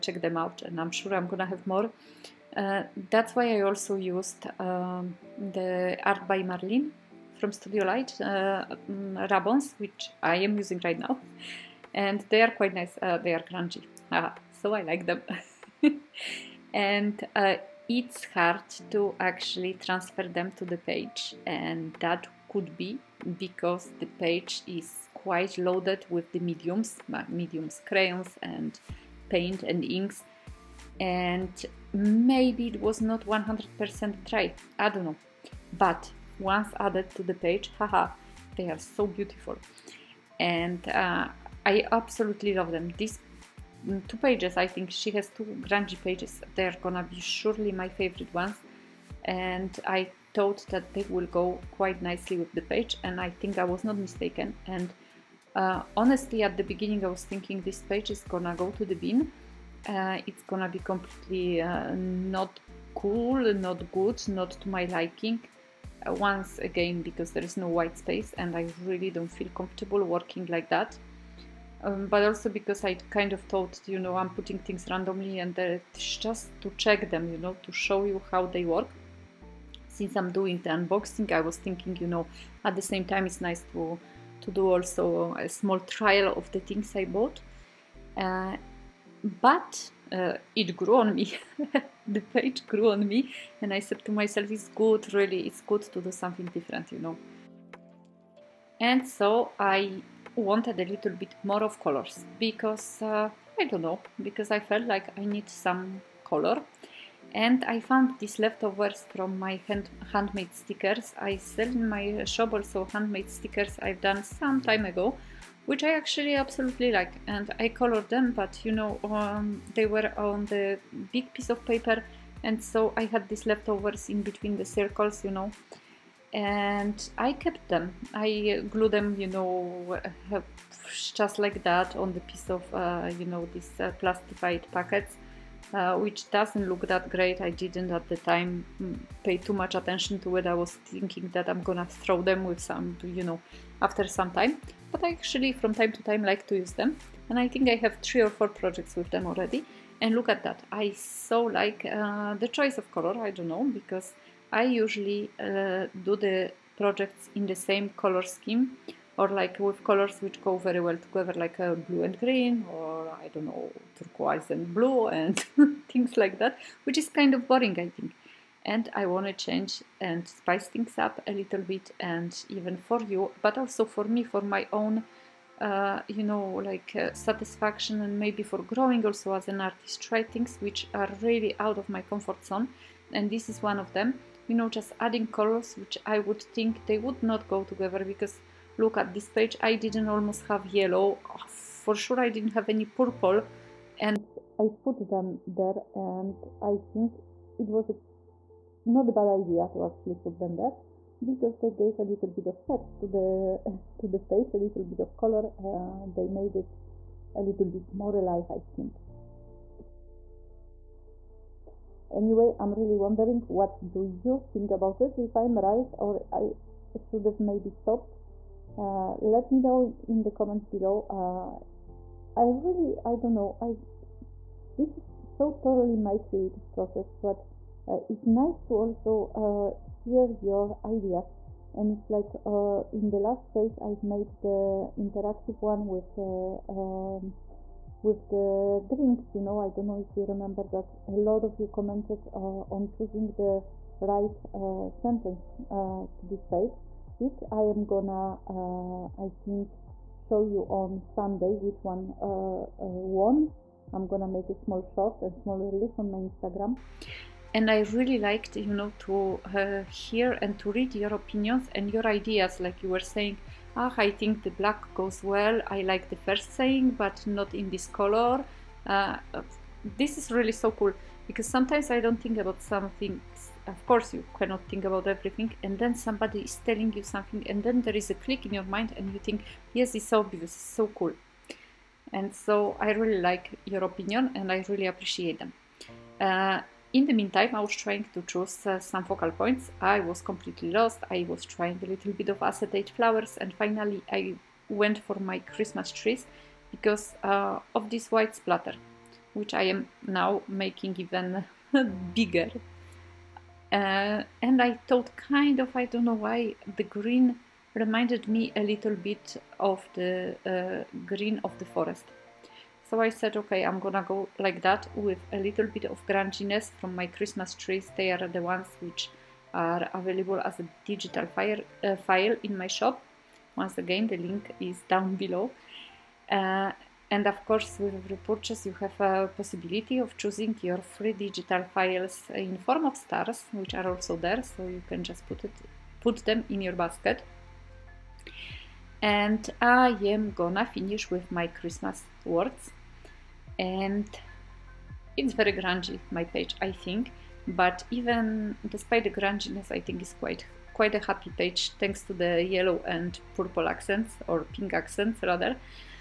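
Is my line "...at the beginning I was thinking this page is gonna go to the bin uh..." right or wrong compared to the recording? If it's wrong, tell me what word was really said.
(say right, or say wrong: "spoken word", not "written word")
right.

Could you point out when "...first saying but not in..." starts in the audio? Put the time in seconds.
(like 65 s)
266 s.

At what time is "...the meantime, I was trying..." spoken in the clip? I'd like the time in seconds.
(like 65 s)
287 s.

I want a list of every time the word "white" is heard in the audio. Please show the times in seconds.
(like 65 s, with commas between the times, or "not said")
67 s, 298 s.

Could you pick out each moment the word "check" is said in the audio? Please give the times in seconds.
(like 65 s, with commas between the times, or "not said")
0 s, 76 s.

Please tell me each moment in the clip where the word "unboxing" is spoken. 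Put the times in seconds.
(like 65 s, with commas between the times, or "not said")
80 s.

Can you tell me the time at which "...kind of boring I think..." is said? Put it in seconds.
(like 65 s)
167 s.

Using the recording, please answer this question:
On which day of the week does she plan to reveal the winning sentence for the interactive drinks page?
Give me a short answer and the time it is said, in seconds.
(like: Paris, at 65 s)
Sunday, at 251 s.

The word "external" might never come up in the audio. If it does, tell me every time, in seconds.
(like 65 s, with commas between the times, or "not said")
not said.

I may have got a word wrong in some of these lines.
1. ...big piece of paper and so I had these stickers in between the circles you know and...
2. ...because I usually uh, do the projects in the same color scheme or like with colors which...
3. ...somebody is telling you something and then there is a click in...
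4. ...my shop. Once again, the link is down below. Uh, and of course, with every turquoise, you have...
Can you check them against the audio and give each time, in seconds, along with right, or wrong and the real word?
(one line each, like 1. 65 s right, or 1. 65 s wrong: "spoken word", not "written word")
1. 121 s wrong: "leftovers", not "stickers"
2. 153 s right
3. 275 s right
4. 322 s wrong: "purchase", not "turquoise".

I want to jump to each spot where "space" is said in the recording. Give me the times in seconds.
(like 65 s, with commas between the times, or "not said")
67 s.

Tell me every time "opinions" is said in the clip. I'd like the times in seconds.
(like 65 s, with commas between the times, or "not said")
261 s, 283 s.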